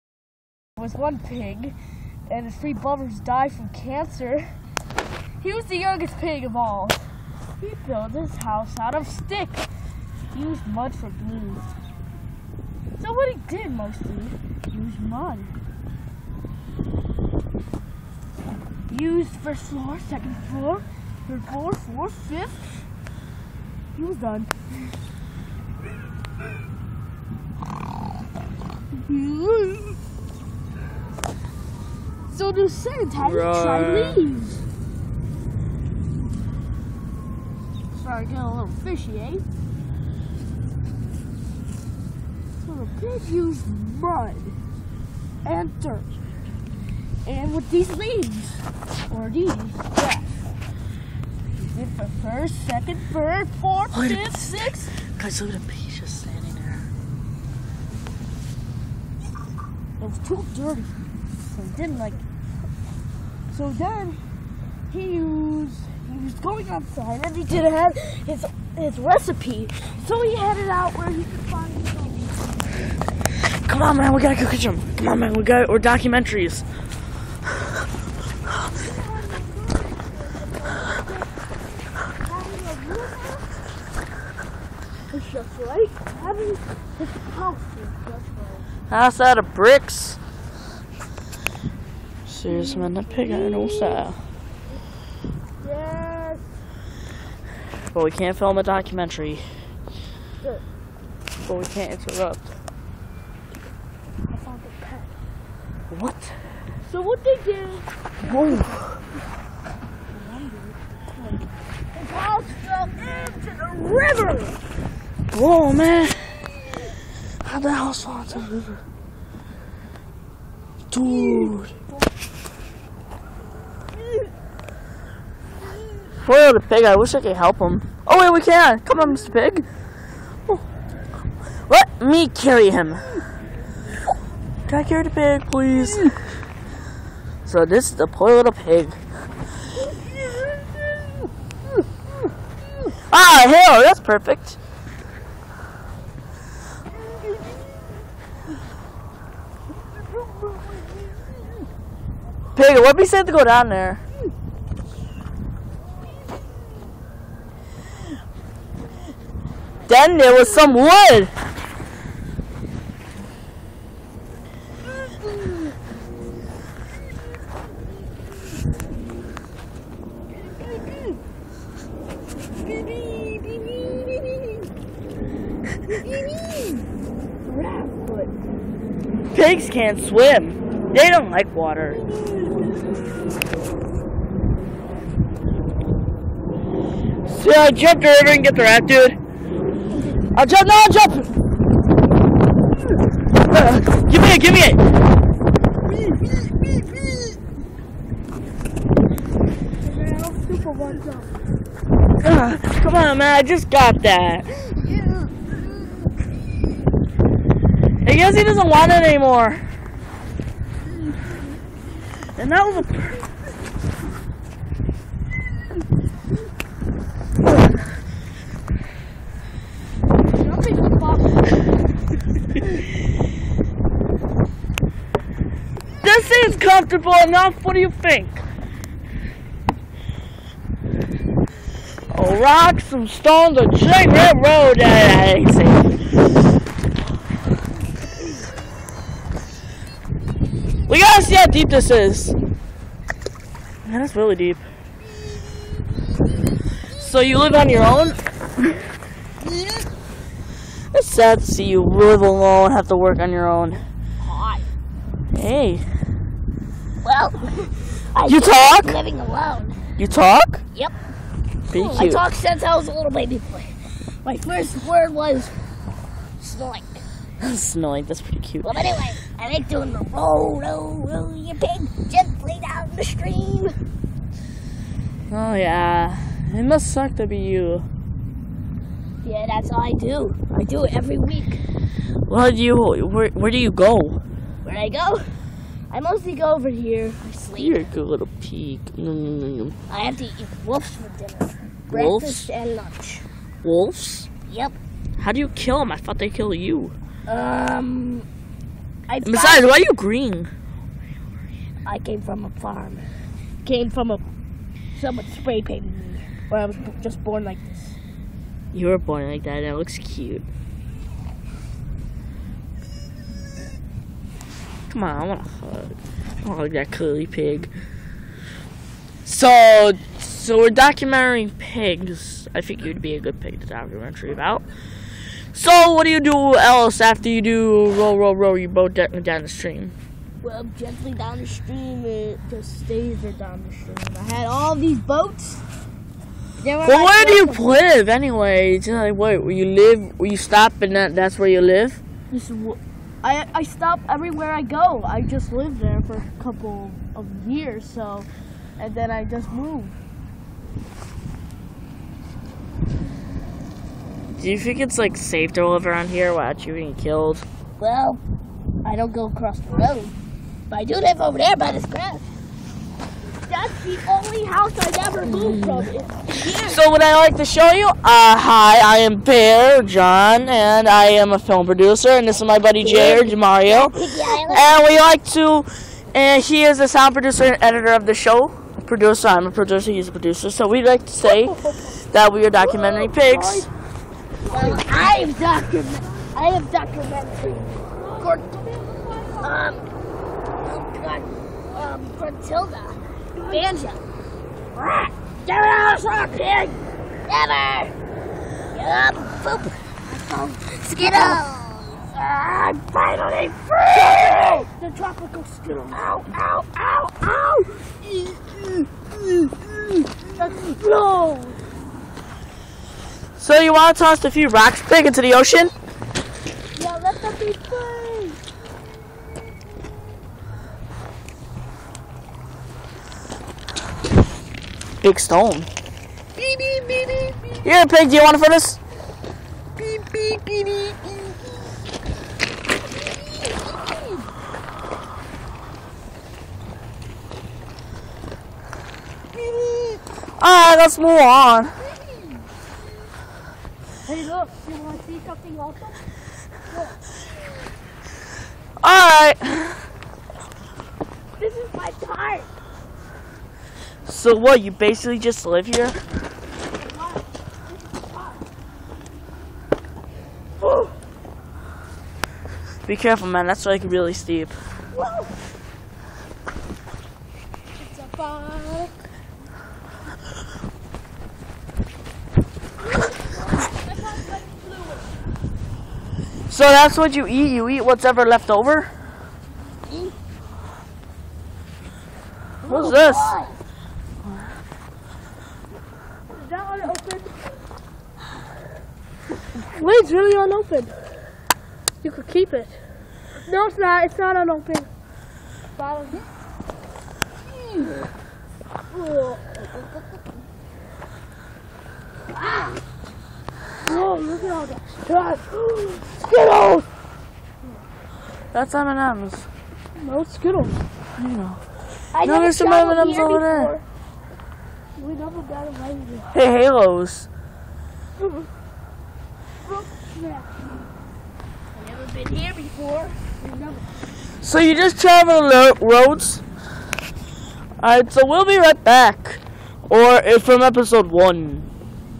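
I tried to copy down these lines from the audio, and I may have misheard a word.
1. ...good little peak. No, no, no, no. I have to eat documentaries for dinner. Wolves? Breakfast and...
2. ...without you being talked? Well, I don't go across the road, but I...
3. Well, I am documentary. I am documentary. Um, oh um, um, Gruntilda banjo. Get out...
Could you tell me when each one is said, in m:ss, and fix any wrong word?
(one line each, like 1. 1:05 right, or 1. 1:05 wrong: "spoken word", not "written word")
1. 4:47 wrong: "wolves", not "documentaries"
2. 5:56 wrong: "killed", not "talked"
3. 6:24 right.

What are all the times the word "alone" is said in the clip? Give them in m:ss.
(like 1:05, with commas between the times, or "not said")
4:12, 4:19.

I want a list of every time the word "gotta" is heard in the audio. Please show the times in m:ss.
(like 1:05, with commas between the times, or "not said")
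1:14, 4:00.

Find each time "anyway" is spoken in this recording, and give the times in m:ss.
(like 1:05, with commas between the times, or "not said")
4:28, 5:38.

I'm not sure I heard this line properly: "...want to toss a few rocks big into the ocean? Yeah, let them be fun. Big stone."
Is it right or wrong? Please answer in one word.
right.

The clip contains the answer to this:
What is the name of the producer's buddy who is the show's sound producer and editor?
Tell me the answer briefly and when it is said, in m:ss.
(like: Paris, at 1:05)
Jay or Mario, at 6:12.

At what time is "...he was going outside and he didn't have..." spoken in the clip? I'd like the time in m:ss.
1:06.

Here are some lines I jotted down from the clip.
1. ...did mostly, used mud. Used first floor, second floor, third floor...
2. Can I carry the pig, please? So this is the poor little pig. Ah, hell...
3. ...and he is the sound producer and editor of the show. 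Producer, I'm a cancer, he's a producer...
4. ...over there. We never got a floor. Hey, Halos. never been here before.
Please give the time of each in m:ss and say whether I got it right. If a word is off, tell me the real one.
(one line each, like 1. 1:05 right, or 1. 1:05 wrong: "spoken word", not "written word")
1. 0:13 right
2. 2:14 right
3. 6:16 wrong: "producer", not "cancer"
4. 8:33 wrong: "razor", not "floor".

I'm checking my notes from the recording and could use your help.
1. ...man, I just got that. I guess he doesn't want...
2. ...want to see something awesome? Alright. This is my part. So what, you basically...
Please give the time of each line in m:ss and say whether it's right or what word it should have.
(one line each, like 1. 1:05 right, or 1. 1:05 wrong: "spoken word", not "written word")
1. 3:23 right
2. 7:24 right.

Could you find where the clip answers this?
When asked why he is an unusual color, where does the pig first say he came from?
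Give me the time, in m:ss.
5:01.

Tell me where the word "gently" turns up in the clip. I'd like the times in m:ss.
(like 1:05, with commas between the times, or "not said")
4:32, 5:30.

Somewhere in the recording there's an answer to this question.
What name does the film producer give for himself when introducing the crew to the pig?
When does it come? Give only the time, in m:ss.
6:08.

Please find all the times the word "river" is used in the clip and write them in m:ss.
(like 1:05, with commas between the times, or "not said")
1:53, 1:58.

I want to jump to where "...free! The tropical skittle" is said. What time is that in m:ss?
6:43.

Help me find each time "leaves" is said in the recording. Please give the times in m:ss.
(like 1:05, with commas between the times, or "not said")
0:34, 0:47.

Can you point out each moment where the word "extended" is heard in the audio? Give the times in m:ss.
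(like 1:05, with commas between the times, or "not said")
not said.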